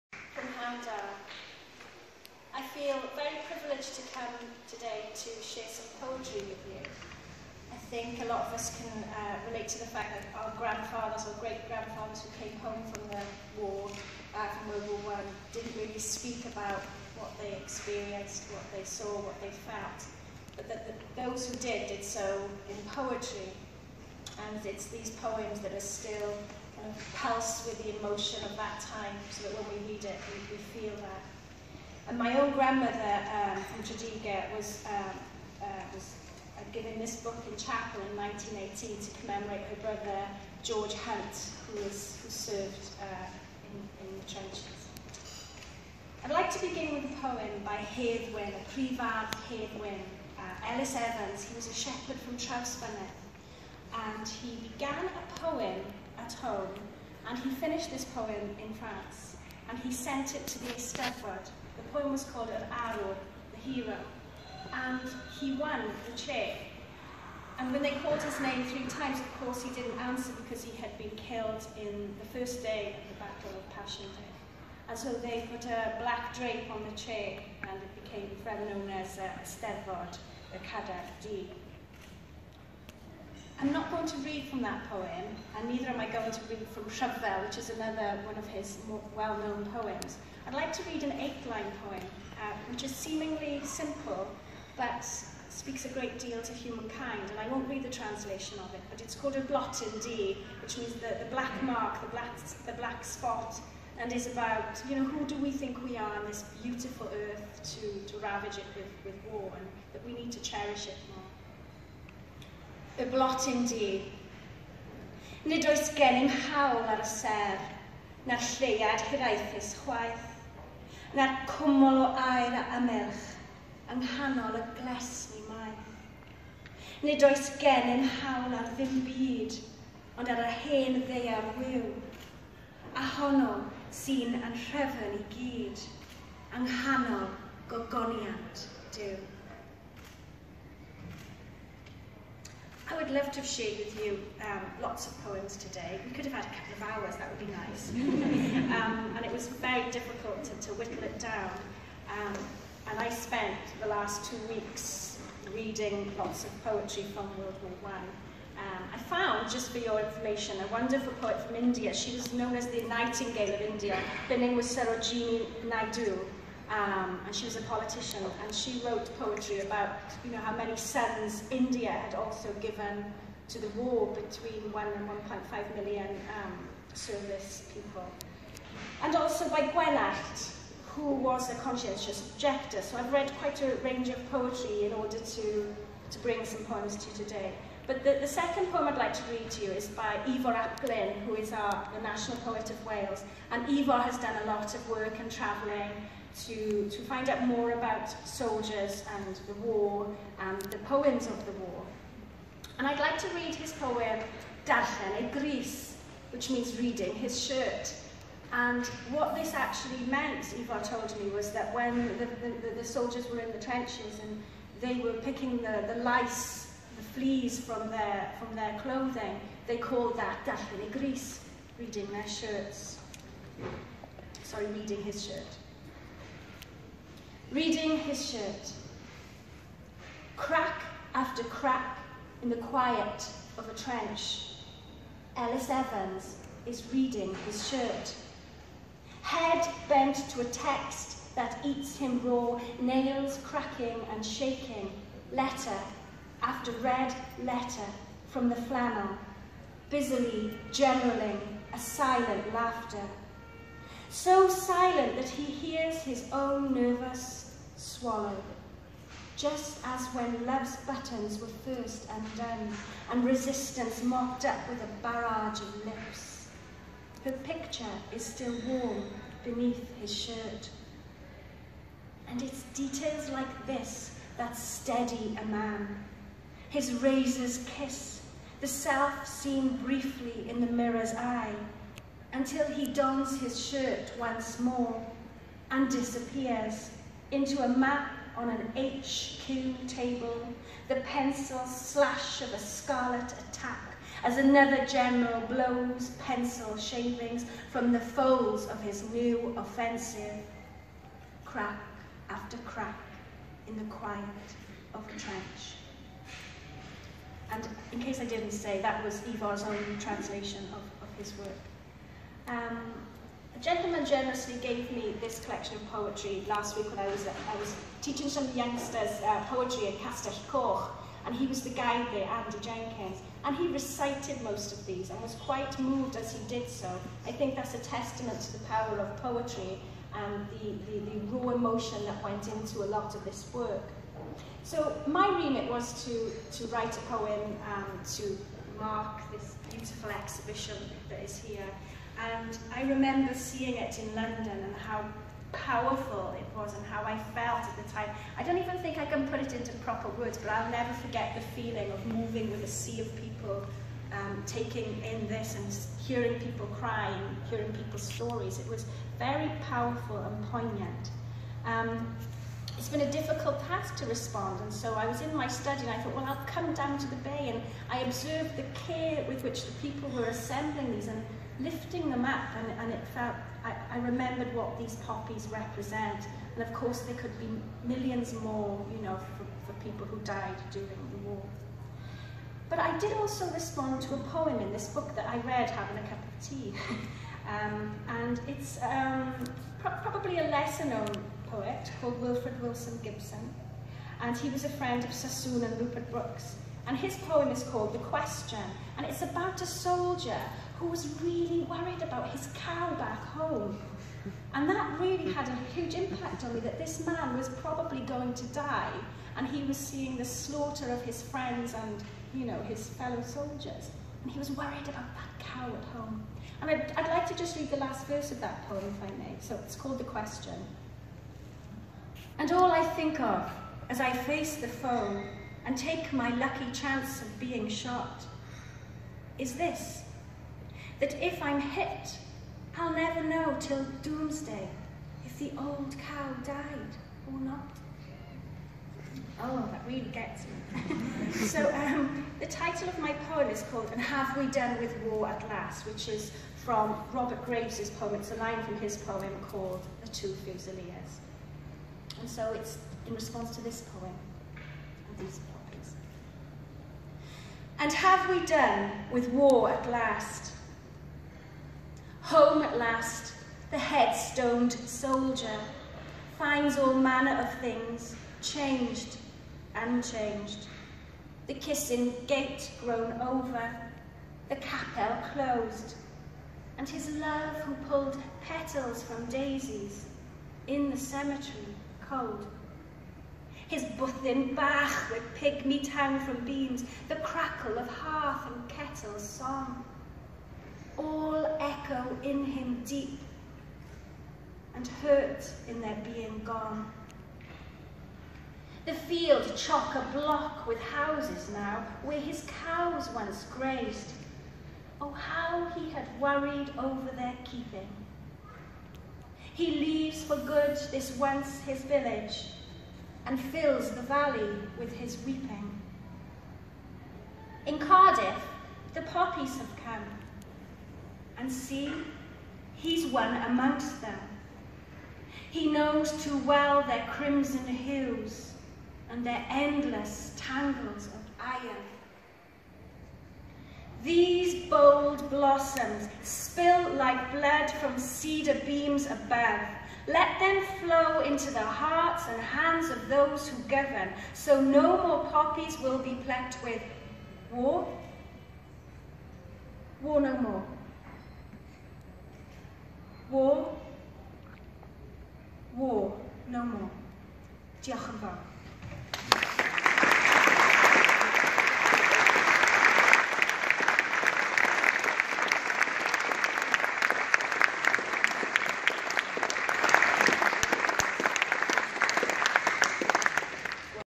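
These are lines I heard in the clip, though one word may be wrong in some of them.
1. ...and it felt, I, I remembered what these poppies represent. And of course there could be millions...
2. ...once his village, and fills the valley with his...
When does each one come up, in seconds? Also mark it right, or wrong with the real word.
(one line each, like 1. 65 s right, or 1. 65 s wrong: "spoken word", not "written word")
1. 372 s right
2. 511 s right.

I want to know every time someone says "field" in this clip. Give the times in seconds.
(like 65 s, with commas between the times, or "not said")
498 s.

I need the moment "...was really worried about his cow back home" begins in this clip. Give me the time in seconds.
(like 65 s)
400 s.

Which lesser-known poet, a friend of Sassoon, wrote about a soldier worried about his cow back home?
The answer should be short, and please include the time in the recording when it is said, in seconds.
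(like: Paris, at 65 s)
Wilfred Wilson Gibson, at 392 s.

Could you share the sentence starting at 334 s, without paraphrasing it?
So my remit was to, to write a poem um, to mark this beautiful exhibition that is here.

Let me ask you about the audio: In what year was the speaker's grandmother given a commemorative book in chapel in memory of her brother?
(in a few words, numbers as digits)
1918.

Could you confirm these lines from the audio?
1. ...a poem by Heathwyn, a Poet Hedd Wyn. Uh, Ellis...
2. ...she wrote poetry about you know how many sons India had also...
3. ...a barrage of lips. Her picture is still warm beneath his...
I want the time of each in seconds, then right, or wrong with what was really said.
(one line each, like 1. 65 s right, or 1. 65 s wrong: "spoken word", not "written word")
1. 47 s wrong: "Prifardd", not "Poet"
2. 168 s right
3. 264 s right.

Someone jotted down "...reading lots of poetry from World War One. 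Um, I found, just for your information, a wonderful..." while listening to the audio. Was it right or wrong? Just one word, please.
right.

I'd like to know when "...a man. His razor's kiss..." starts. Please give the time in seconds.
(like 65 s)
275 s.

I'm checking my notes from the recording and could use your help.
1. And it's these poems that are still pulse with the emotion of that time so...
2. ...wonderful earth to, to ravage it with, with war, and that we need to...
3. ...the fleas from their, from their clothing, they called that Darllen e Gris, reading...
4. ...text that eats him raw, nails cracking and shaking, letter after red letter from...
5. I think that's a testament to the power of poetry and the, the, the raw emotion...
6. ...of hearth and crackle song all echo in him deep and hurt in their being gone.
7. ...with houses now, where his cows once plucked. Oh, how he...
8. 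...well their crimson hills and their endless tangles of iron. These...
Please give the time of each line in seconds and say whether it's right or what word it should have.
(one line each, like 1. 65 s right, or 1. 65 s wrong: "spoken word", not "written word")
1. 24 s right
2. 106 s wrong: "beautiful", not "wonderful"
3. 216 s right
4. 240 s right
5. 327 s right
6. 487 s wrong: "kettle", not "crackle"
7. 500 s wrong: "grazed", not "plucked"
8. 526 s right.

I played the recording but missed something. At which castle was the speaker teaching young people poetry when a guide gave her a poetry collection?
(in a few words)
Castell Coch.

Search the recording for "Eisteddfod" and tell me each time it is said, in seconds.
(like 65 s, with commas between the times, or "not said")
60 s, 79 s.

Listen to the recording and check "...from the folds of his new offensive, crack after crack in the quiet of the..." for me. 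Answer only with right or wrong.
right.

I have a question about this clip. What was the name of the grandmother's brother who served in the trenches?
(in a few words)
George Hunt.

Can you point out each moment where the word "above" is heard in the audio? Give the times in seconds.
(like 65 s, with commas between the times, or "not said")
539 s.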